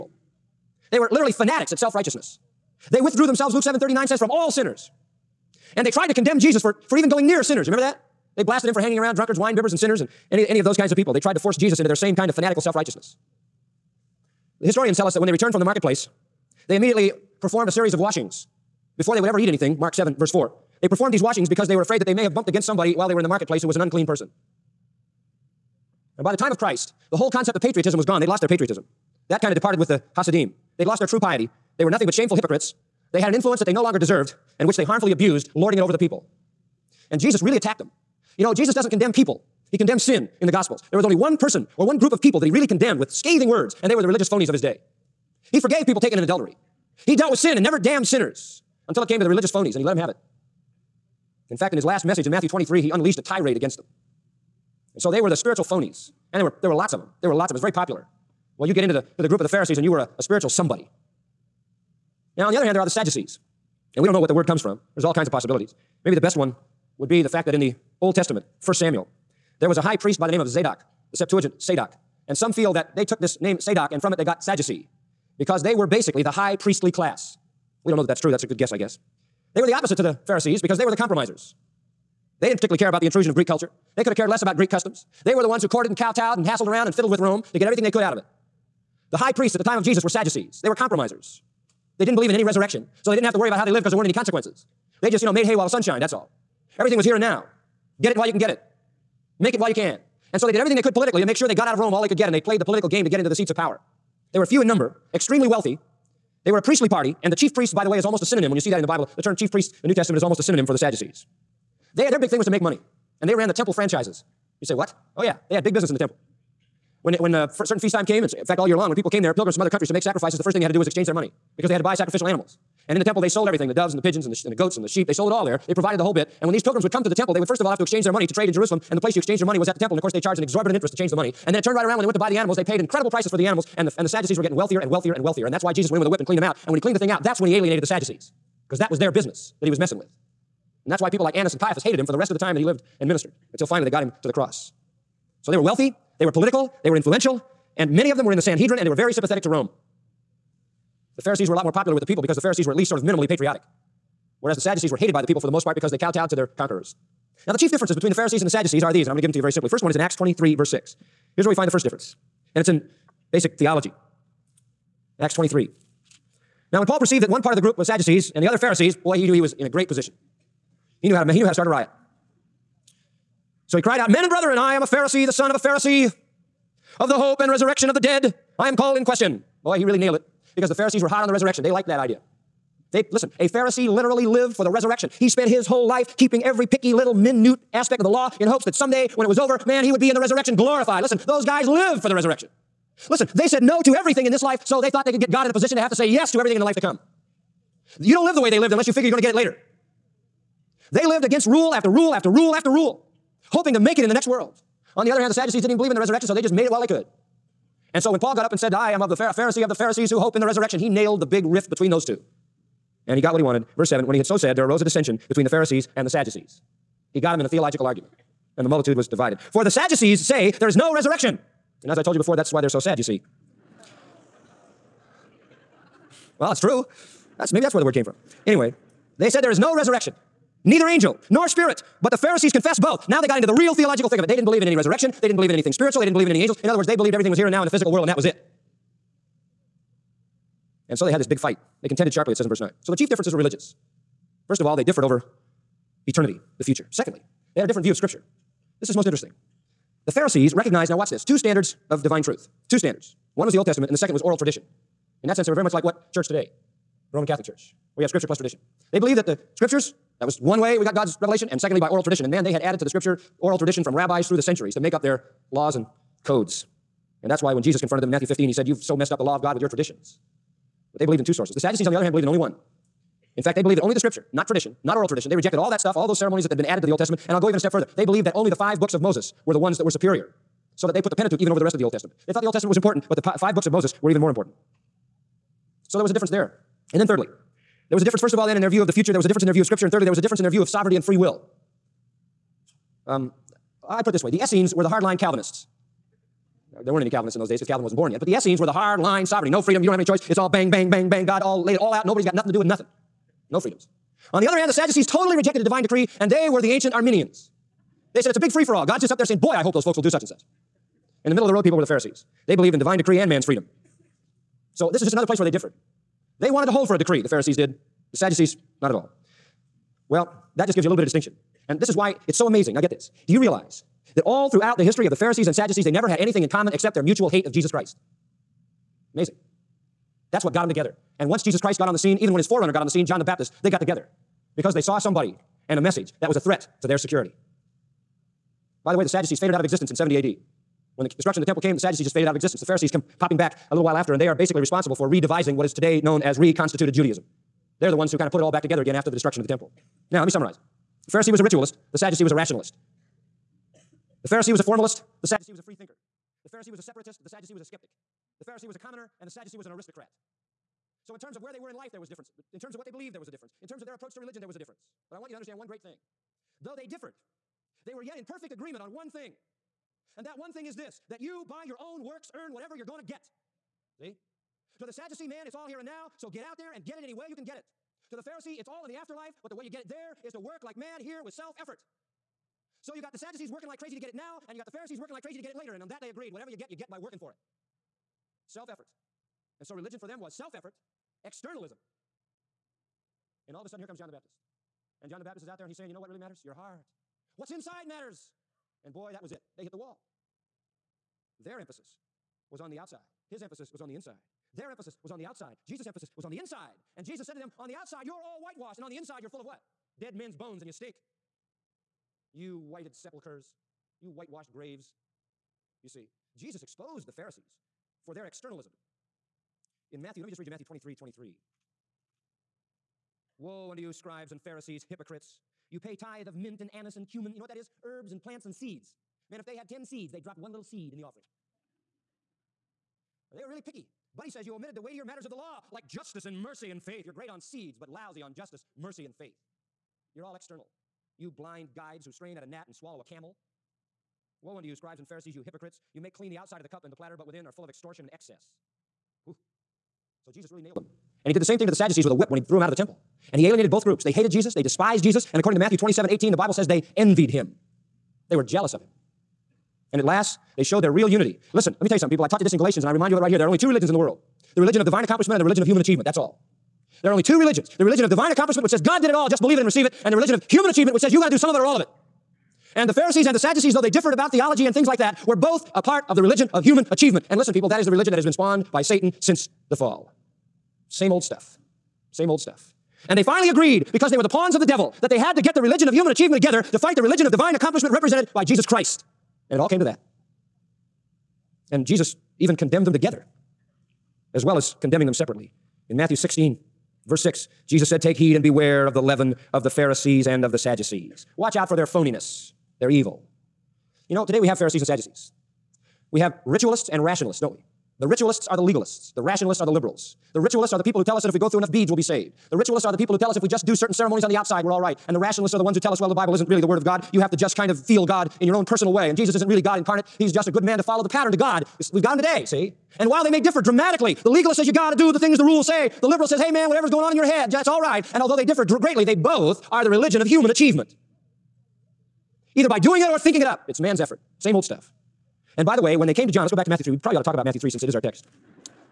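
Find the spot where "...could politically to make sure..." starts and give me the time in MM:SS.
01:40.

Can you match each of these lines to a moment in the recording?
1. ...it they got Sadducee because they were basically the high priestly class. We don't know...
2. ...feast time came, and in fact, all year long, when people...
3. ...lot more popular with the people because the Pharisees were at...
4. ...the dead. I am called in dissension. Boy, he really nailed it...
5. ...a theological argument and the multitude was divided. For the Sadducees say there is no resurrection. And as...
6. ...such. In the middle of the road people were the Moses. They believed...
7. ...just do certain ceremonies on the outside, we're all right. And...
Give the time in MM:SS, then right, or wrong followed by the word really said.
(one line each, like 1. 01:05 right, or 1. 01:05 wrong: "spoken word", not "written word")
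1. 01:14 right
2. 01:57 right
3. 02:31 right
4. 02:57 wrong: "question", not "dissension"
5. 03:37 right
6. 05:10 wrong: "Pharisees", not "Moses"
7. 08:33 right.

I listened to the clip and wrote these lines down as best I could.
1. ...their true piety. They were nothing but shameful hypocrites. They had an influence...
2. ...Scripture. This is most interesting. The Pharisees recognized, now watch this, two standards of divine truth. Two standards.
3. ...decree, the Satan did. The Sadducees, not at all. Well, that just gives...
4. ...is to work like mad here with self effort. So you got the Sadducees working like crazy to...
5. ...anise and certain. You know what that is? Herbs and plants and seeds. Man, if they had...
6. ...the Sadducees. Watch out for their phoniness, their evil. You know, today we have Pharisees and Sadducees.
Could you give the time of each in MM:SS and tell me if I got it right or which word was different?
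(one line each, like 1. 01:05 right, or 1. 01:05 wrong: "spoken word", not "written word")
1. 00:30 right
2. 04:07 right
3. 05:16 wrong: "Pharisees", not "Satan"
4. 06:20 right
5. 07:06 wrong: "cumin", not "certain"
6. 08:20 right.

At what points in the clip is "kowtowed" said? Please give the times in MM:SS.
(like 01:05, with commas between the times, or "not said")
01:25, 02:35.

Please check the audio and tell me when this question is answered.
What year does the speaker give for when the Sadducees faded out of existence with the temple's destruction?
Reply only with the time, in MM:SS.
05:39.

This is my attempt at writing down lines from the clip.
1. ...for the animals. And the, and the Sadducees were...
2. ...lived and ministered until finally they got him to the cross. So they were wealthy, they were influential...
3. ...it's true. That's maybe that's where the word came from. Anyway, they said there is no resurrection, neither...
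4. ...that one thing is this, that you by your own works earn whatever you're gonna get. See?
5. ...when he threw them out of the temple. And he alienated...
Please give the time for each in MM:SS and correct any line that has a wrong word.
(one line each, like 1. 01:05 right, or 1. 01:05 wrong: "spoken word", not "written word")
1. 02:13 right
2. 02:22 wrong: "political", not "influential"
3. 03:46 right
4. 06:10 right
5. 07:32 right.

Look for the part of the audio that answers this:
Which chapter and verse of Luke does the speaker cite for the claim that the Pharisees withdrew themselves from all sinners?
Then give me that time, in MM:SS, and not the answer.
00:03.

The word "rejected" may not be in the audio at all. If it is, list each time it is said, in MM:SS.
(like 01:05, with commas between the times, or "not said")
04:35, 05:05.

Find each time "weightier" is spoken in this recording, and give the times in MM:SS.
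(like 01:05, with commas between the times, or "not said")
07:14.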